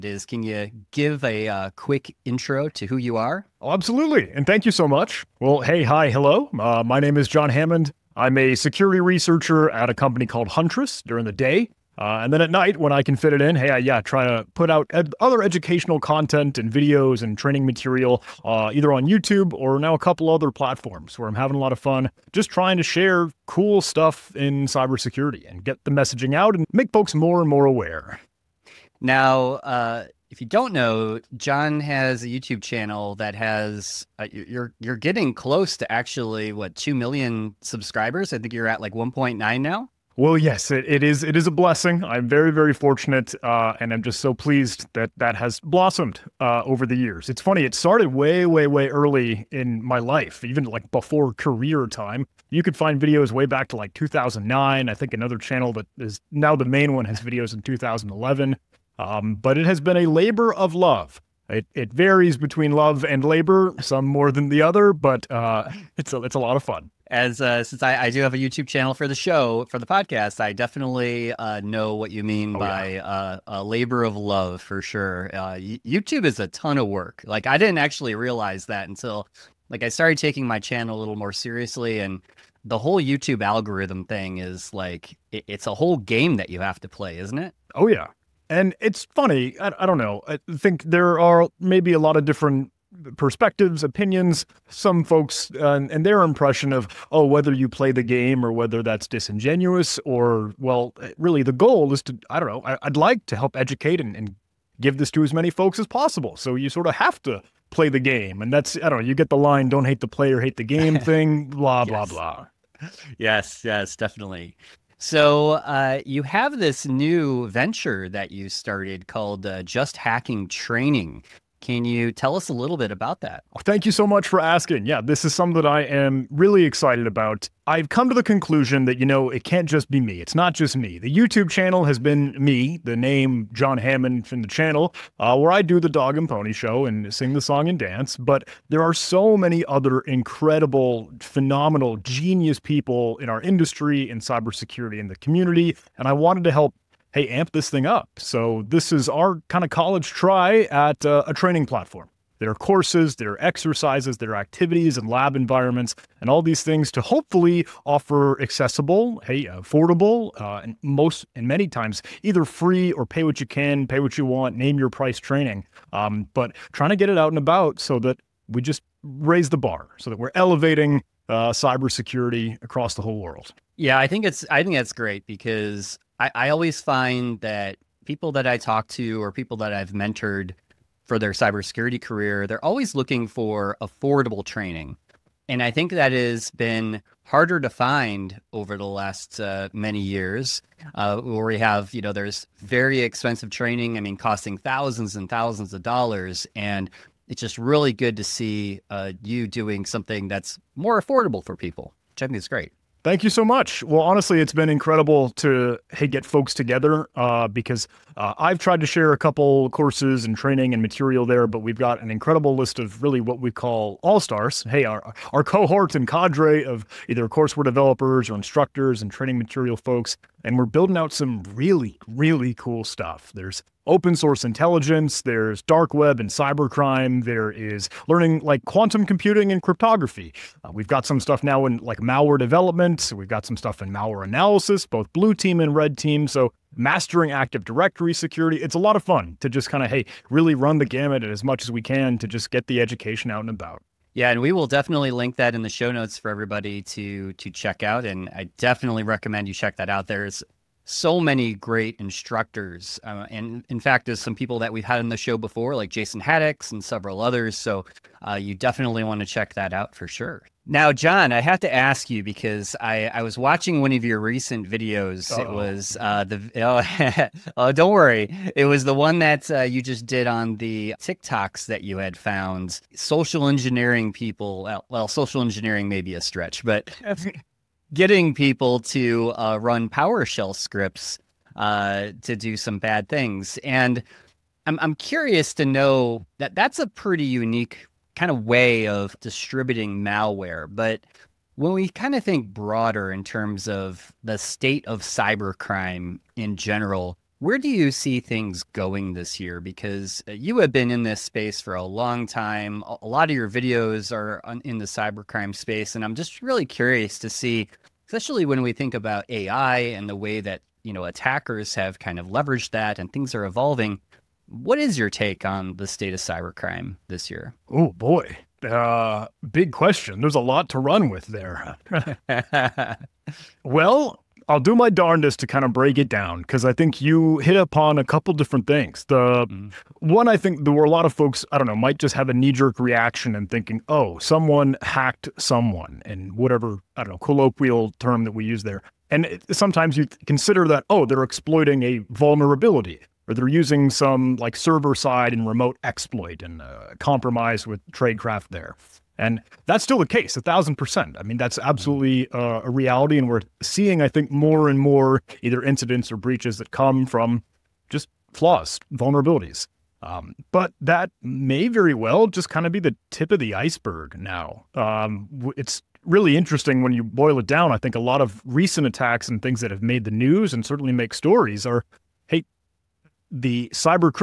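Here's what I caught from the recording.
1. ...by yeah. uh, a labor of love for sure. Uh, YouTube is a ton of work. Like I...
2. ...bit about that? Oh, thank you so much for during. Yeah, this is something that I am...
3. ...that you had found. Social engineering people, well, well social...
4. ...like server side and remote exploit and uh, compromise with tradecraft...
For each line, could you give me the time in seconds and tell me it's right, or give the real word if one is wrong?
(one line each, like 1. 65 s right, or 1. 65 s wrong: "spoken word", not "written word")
1. 72 s right
2. 122 s wrong: "asking", not "during"
3. 271 s right
4. 344 s right.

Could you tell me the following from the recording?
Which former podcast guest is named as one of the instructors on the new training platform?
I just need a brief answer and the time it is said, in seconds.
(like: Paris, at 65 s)
Jason Haddix, at 255 s.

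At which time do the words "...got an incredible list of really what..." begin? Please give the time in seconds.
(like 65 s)
211 s.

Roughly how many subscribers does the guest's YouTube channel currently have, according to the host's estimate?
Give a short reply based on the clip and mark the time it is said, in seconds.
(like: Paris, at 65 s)
1.9 million, at 38 s.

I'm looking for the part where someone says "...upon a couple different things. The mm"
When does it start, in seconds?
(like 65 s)
327 s.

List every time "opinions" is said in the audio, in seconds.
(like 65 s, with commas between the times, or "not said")
93 s.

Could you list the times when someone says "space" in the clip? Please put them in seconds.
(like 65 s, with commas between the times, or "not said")
301 s, 305 s.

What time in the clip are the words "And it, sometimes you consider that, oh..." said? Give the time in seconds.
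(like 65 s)
339 s.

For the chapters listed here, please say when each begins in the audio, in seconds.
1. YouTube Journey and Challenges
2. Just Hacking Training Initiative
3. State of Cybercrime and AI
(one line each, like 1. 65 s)
1. 28 s
2. 114 s
3. 290 s.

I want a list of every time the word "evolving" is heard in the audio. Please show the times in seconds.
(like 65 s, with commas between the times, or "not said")
313 s.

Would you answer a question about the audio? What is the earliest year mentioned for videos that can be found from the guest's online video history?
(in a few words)
2009.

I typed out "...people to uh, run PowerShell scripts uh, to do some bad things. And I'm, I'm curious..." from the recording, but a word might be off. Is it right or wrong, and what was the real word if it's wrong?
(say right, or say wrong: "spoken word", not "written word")
right.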